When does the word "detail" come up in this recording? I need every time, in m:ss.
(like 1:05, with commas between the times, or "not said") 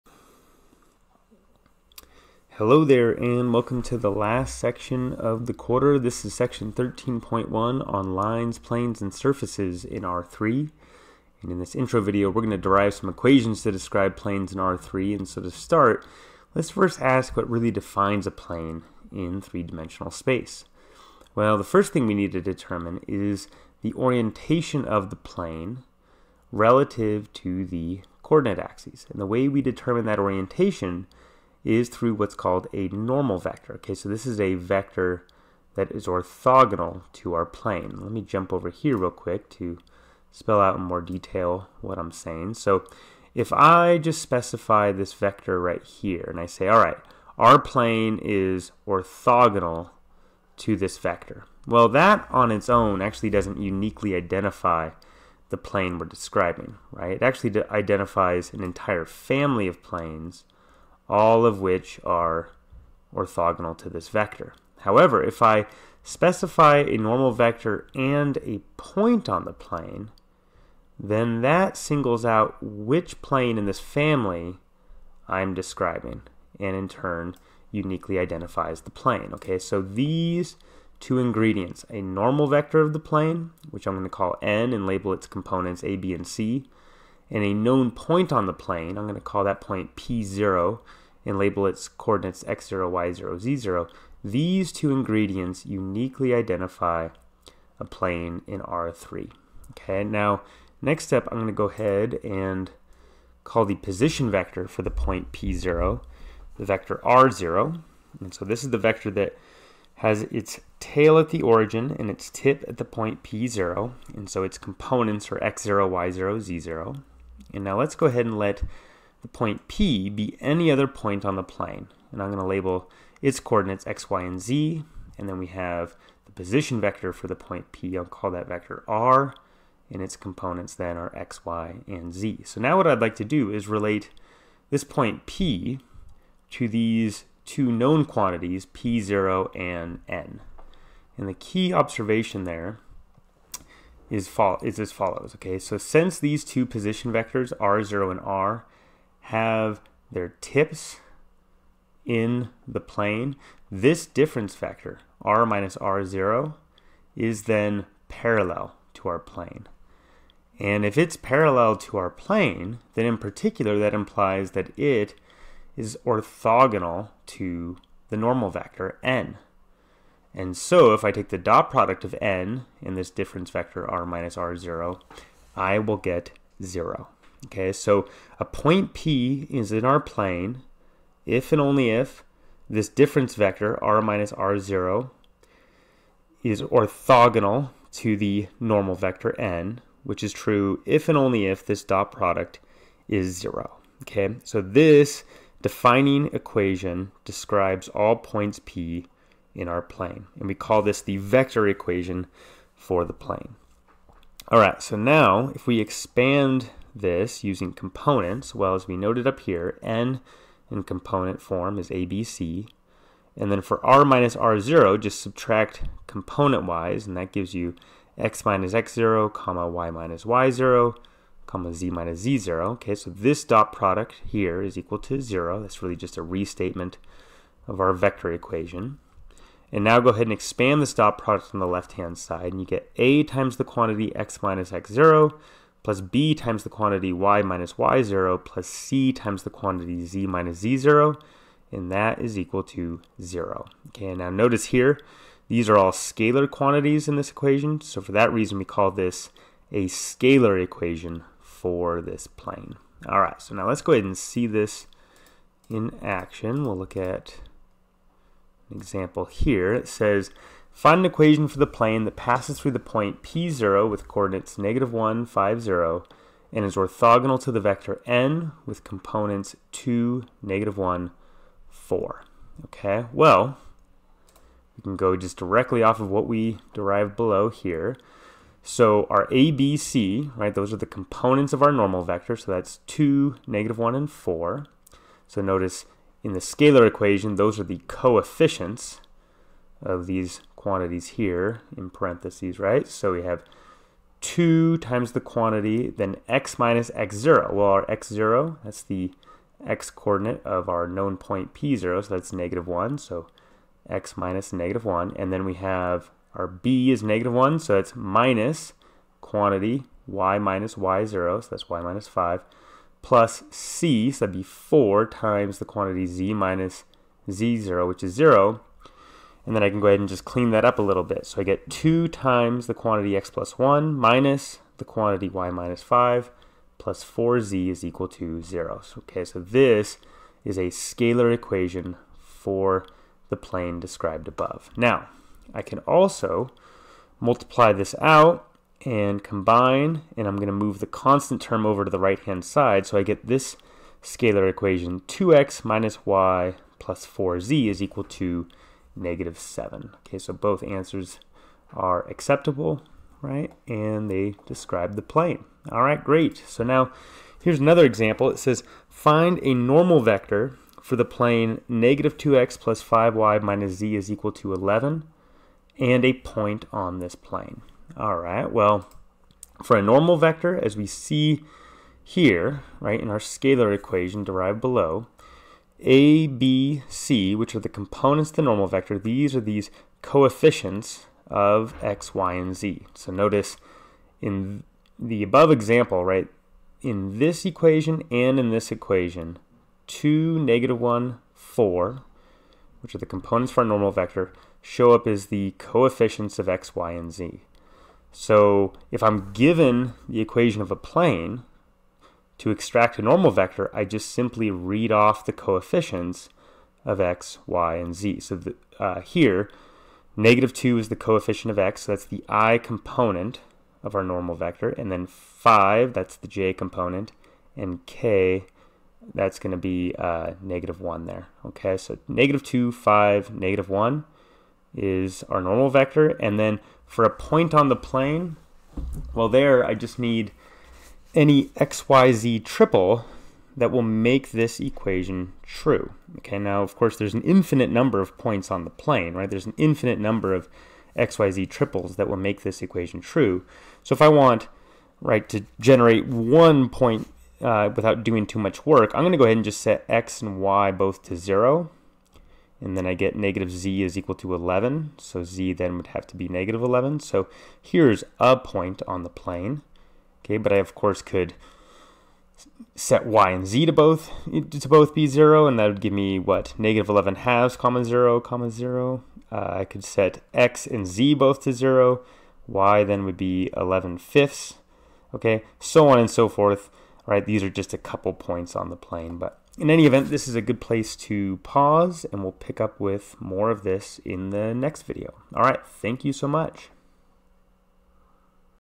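0:41.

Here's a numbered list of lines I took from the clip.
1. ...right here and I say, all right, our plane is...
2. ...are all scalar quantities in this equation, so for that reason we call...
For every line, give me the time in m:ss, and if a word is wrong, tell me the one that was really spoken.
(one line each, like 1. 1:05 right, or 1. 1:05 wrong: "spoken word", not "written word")
1. 0:45 right
2. 4:05 right.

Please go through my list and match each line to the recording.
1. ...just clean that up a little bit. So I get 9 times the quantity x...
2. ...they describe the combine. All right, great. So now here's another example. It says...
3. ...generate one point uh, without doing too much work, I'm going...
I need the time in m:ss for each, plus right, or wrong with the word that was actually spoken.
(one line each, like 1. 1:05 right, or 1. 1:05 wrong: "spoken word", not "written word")
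1. 5:20 wrong: "2", not "9"
2. 5:54 wrong: "plane", not "combine"
3. 7:25 right.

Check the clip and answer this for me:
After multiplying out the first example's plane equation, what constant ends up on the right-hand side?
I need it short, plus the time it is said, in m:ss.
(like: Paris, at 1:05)
-7, at 5:48.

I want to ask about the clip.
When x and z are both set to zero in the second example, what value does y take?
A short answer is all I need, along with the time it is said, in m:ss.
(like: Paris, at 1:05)
11/5, at 7:53.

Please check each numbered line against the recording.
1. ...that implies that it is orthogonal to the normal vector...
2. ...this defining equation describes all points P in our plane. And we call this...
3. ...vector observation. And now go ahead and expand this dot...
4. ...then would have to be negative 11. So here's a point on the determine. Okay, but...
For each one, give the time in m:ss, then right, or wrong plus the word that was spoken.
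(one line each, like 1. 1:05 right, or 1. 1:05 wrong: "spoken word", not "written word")
1. 2:43 right
2. 3:14 right
3. 3:47 wrong: "equation", not "observation"
4. 7:35 wrong: "plane", not "determine".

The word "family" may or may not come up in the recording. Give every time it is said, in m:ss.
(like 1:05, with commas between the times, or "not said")
0:59, 1:13.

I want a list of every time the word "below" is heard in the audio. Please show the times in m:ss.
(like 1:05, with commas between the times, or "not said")
4:37, 6:14.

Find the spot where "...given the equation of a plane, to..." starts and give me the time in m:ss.
6:39.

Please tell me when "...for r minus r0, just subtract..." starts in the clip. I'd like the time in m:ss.
3:33.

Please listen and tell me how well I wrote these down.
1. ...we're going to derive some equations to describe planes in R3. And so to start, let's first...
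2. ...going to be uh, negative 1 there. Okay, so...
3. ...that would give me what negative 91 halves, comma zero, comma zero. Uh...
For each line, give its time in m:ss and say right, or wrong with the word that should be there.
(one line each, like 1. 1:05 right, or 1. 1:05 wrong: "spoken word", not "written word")
1. 0:12 right
2. 6:59 right
3. 7:45 wrong: "11", not "91".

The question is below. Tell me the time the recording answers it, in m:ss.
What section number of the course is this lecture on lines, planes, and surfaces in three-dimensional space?
0:06.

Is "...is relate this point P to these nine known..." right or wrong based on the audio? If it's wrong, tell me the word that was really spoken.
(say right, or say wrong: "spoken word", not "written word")
wrong: "two", not "nine".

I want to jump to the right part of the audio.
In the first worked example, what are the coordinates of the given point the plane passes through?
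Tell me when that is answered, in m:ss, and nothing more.
4:24.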